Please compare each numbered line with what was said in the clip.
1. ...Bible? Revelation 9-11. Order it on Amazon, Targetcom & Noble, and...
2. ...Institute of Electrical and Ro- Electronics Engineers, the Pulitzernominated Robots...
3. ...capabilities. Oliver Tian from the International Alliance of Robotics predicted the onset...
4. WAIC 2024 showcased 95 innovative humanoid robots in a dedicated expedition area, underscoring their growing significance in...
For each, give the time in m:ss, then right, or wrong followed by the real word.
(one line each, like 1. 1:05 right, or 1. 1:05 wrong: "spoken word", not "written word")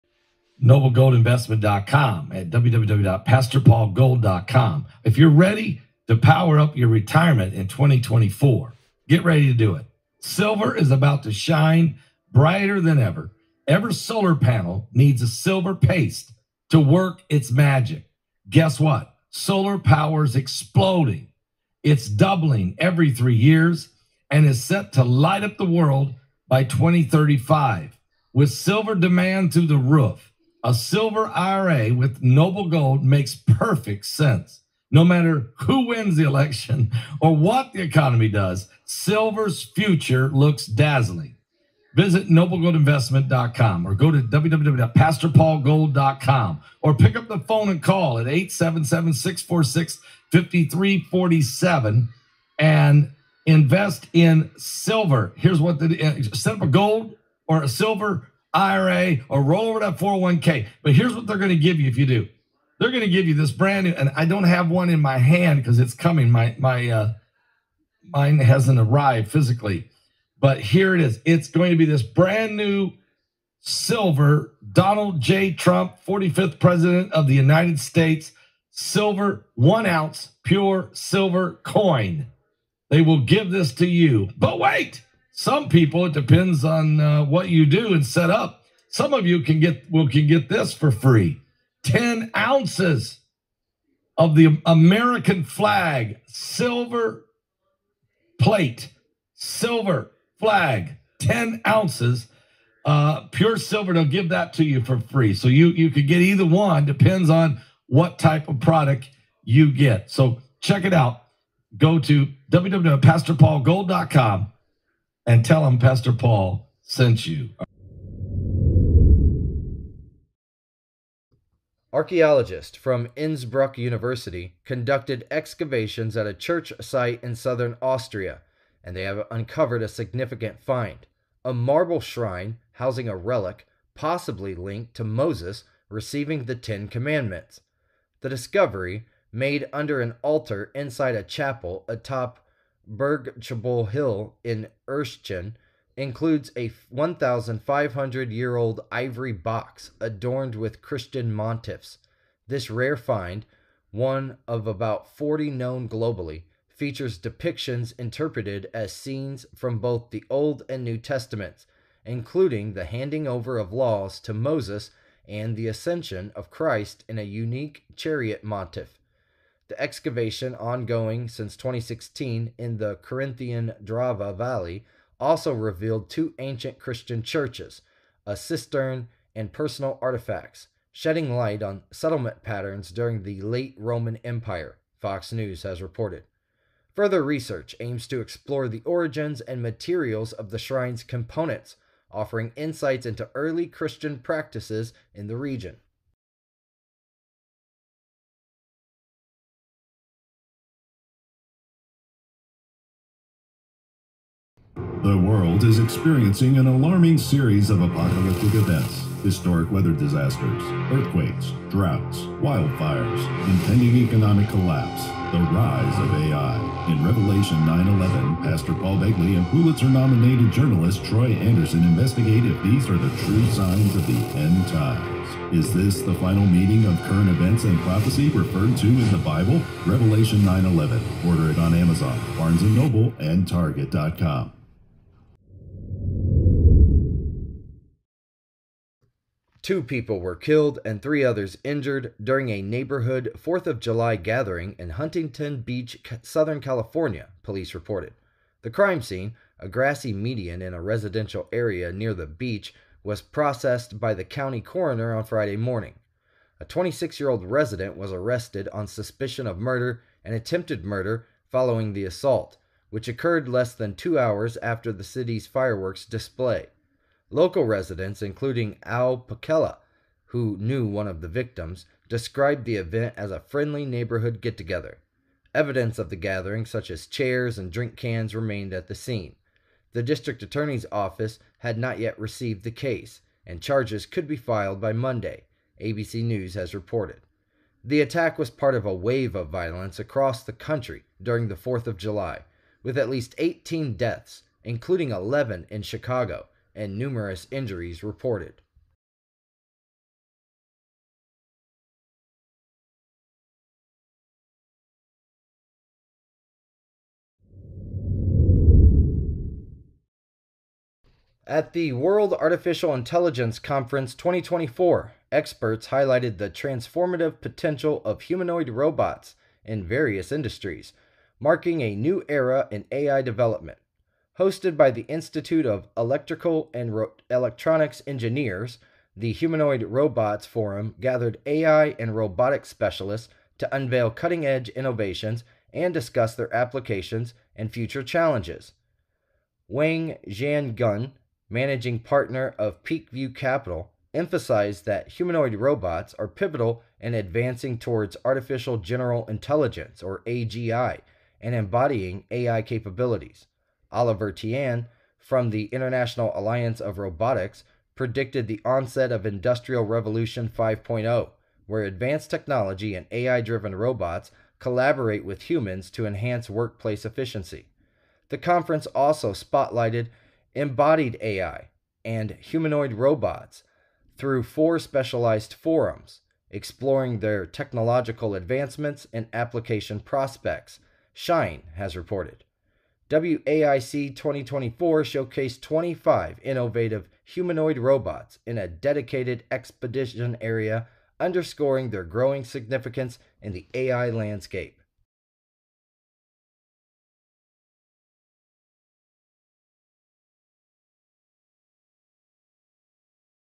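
1. 3:49 wrong: "Barnes", not "Targetcom"
2. 5:25 wrong: "Humanoid", not "Pulitzernominated"
3. 5:52 right
4. 6:23 wrong: "25", not "95".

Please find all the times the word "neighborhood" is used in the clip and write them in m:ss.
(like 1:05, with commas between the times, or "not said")
4:02, 4:33.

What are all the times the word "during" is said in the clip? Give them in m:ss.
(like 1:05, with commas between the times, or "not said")
3:02, 4:02, 4:51.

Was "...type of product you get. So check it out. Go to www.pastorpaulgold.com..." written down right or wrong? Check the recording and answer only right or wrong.
right.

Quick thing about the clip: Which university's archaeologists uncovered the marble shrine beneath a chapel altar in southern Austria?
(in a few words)
Innsbruck University.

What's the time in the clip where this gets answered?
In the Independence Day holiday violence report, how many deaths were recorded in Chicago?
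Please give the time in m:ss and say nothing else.
4:55.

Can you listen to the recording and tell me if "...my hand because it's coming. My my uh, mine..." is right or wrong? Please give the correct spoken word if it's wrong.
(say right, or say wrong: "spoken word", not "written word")
right.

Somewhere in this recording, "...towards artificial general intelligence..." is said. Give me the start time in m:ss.
5:47.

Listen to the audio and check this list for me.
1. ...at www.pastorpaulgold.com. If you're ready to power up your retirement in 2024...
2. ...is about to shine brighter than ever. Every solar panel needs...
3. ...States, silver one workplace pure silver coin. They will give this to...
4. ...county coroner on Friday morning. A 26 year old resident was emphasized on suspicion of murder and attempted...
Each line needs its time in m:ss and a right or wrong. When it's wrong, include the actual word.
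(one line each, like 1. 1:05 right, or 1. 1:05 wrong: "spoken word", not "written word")
1. 0:02 right
2. 0:10 right
3. 1:17 wrong: "ounce", not "workplace"
4. 4:14 wrong: "arrested", not "emphasized".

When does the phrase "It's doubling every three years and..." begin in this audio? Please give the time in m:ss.
0:21.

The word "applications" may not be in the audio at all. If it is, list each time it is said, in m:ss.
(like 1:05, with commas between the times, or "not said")
5:36, 6:19.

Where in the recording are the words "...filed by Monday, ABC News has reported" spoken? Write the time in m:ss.
4:44.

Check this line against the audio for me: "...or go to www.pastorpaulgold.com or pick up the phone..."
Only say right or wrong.
right.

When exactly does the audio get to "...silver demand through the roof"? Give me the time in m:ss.
0:28.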